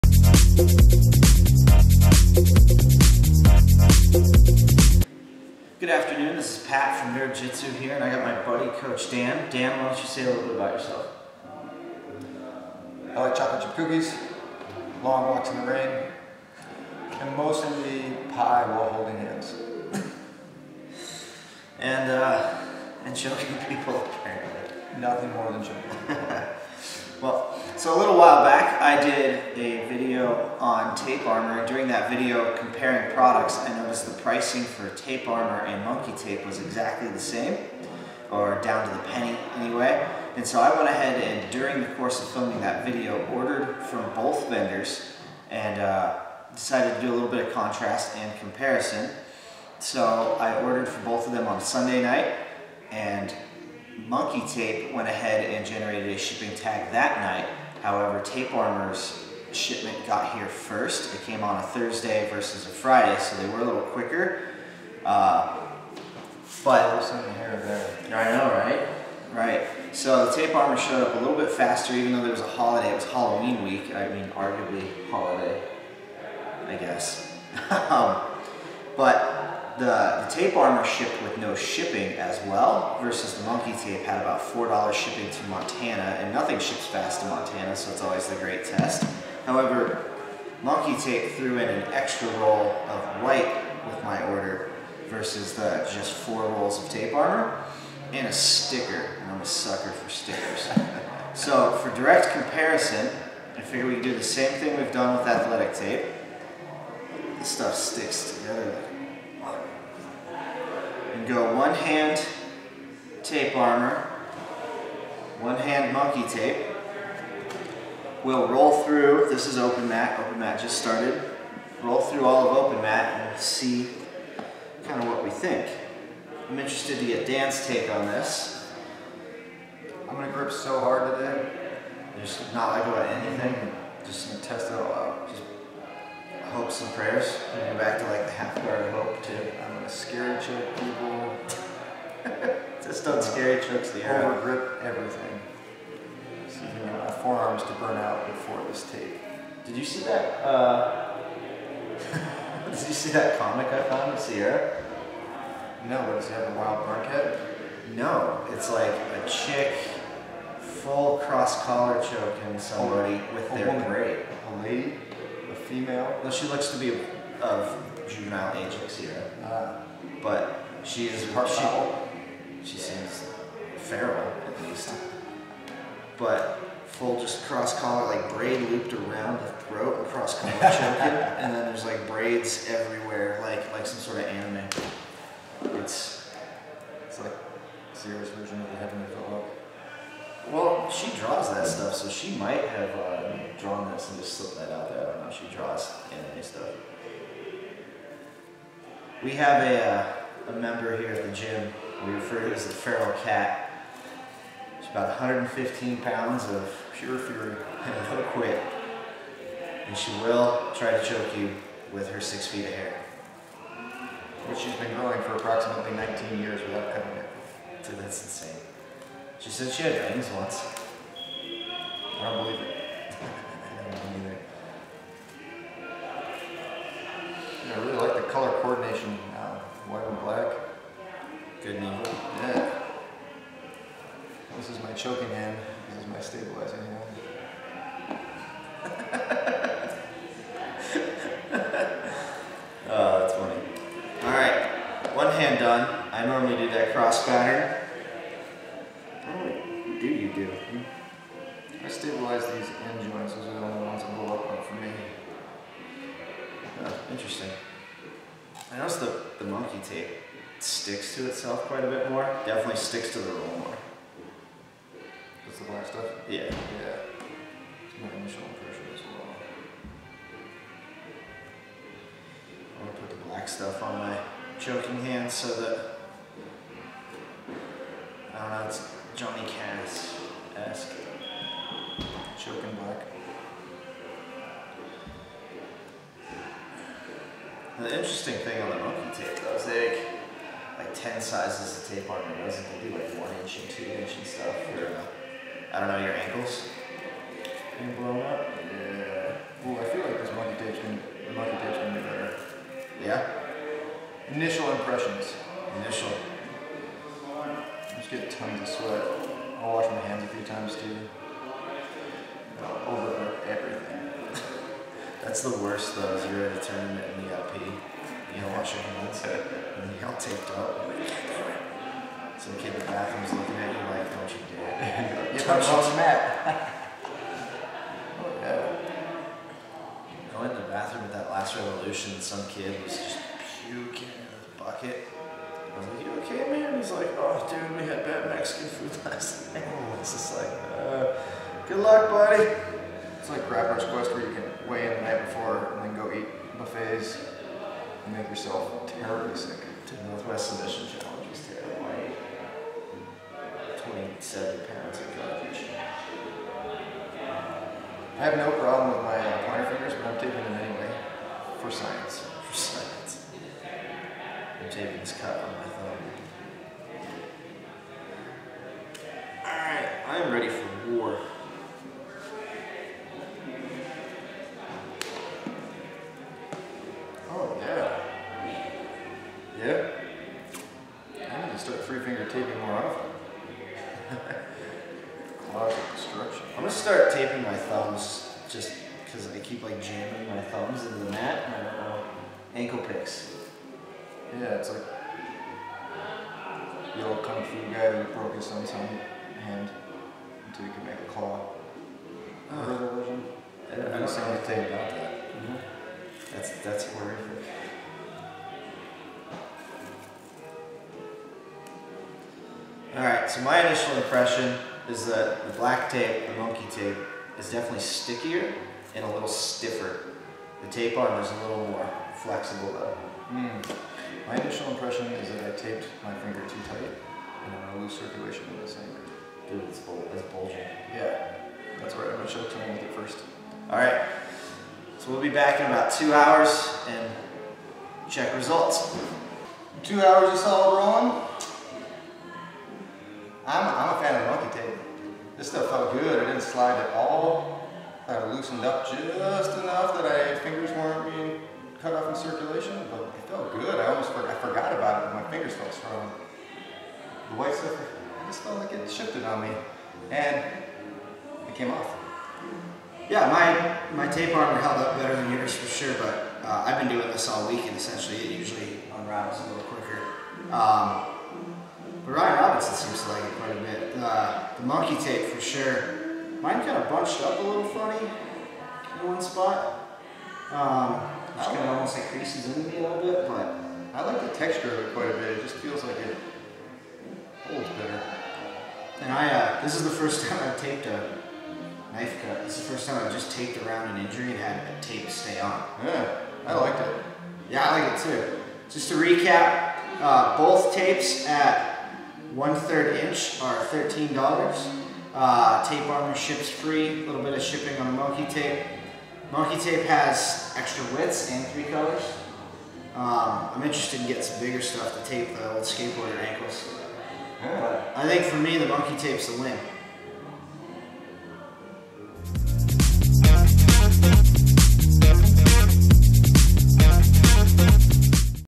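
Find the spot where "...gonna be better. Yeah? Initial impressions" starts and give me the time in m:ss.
5:01.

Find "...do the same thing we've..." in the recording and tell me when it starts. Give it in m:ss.
1:44.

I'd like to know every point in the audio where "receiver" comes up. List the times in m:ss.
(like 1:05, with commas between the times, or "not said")
not said.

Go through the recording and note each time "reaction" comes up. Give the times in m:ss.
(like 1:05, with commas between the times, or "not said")
not said.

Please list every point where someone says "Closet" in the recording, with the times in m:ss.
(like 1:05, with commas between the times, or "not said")
6:25.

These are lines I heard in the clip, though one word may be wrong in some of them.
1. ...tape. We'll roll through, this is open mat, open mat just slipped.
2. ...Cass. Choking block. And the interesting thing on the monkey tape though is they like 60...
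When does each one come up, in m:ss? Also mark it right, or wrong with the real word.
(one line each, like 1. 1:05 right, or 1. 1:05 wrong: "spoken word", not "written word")
1. 1:56 wrong: "started", not "slipped"
2. 4:39 wrong: "10", not "60".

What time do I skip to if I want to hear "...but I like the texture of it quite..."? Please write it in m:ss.
8:03.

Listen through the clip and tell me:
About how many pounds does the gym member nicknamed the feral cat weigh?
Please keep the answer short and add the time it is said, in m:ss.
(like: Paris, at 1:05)
115, at 3:25.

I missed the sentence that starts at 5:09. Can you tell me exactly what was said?
I wash my hands a few times too.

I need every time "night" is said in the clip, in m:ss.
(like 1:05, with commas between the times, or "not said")
0:52, 0:57, 5:39, 5:45.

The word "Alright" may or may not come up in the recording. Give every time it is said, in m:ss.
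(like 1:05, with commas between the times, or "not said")
6:09.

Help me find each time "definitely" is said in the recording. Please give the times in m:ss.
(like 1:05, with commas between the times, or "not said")
4:22, 6:57.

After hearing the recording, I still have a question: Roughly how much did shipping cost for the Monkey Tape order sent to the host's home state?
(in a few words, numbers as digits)
$4.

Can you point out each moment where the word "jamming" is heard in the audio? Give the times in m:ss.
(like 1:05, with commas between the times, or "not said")
6:29.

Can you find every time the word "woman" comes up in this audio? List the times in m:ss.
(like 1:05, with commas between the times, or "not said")
2:43.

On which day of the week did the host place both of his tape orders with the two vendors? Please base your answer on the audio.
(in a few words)
Sunday.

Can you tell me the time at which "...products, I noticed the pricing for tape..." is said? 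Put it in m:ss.
0:33.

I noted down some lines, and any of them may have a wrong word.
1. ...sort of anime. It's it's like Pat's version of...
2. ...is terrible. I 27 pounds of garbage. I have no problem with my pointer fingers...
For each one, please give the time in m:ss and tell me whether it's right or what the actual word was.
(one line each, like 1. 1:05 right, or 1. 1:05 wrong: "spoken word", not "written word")
1. 3:03 wrong: "Zero", not "Pat"
2. 5:51 right.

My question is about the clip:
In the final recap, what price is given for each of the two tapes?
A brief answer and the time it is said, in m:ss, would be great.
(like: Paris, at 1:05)
$13, at 8:23.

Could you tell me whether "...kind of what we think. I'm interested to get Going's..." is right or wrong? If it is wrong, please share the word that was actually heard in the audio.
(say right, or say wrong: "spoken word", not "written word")
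wrong: "Dan", not "Going".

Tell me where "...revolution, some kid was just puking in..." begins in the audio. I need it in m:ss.
5:31.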